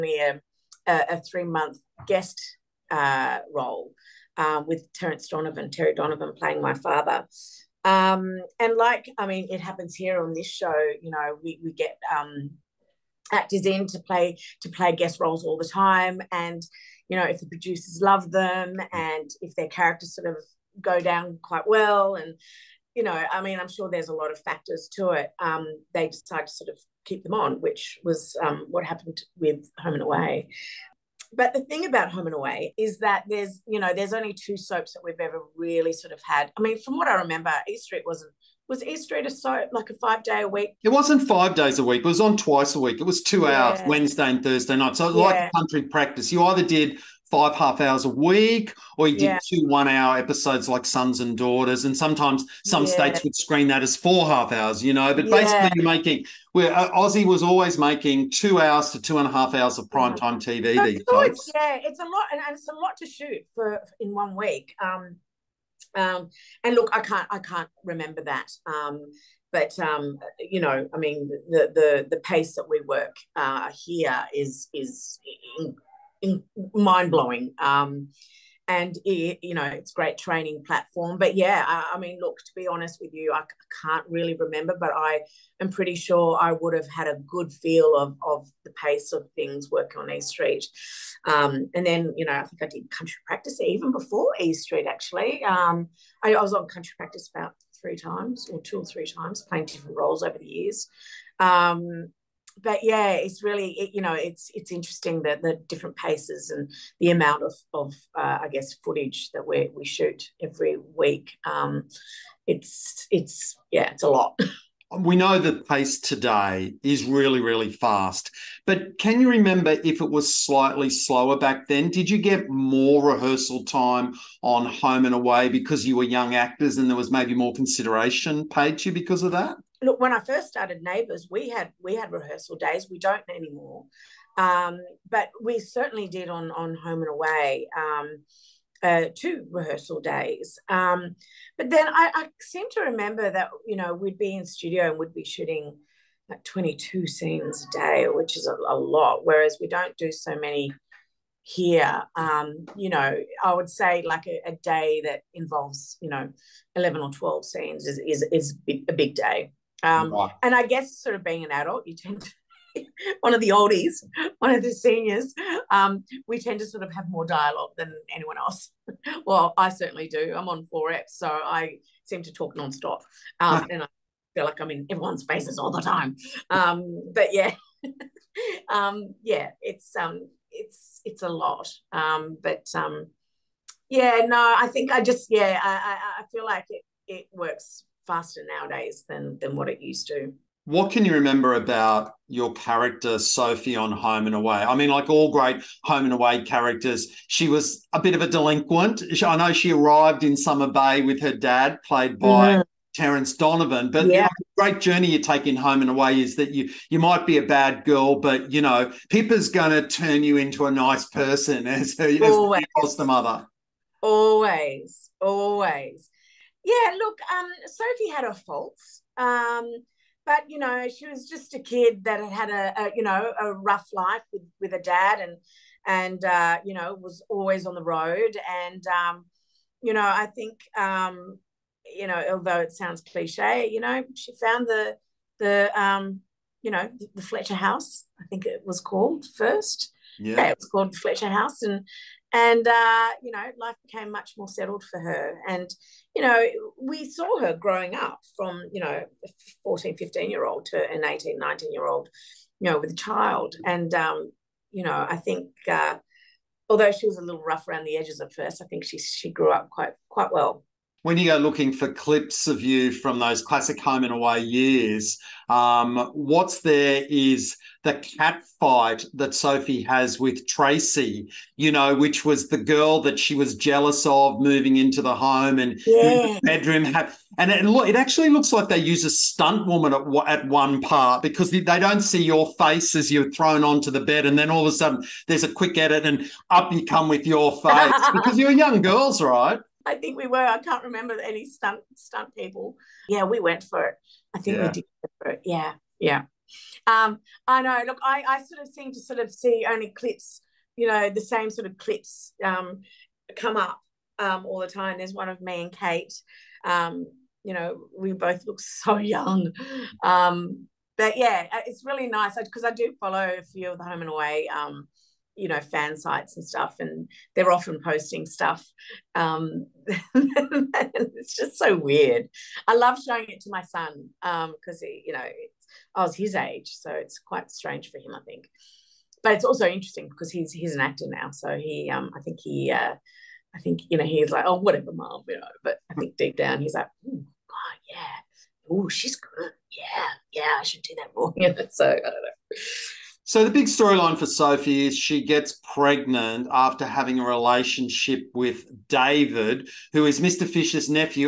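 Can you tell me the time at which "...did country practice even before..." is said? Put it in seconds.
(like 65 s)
92 s.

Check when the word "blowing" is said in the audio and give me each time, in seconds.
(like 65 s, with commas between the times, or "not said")
77 s.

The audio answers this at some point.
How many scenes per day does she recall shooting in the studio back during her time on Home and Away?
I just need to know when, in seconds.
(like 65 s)
146 s.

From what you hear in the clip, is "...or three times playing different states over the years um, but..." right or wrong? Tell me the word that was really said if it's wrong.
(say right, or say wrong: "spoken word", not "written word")
wrong: "roles", not "states".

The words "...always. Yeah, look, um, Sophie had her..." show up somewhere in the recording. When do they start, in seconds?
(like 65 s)
215 s.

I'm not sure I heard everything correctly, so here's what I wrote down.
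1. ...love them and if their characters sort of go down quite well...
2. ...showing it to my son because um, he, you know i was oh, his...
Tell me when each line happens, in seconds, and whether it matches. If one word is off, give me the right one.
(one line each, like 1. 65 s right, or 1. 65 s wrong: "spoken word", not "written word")
1. 18 s right
2. 323 s right.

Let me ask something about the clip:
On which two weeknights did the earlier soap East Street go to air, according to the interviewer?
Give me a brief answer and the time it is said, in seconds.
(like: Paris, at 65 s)
Wednesday and Thursday, at 43 s.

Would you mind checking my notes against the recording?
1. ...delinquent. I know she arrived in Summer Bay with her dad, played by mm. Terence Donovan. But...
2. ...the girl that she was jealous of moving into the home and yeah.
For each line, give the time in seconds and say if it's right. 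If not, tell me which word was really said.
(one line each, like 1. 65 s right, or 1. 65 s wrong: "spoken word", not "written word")
1. 198 s right
2. 272 s right.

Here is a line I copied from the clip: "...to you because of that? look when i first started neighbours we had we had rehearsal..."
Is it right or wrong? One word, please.
right.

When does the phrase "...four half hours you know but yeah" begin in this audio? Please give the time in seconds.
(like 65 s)
53 s.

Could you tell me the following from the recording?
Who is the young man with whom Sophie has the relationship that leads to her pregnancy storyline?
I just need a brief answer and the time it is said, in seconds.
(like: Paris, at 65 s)
David, at 348 s.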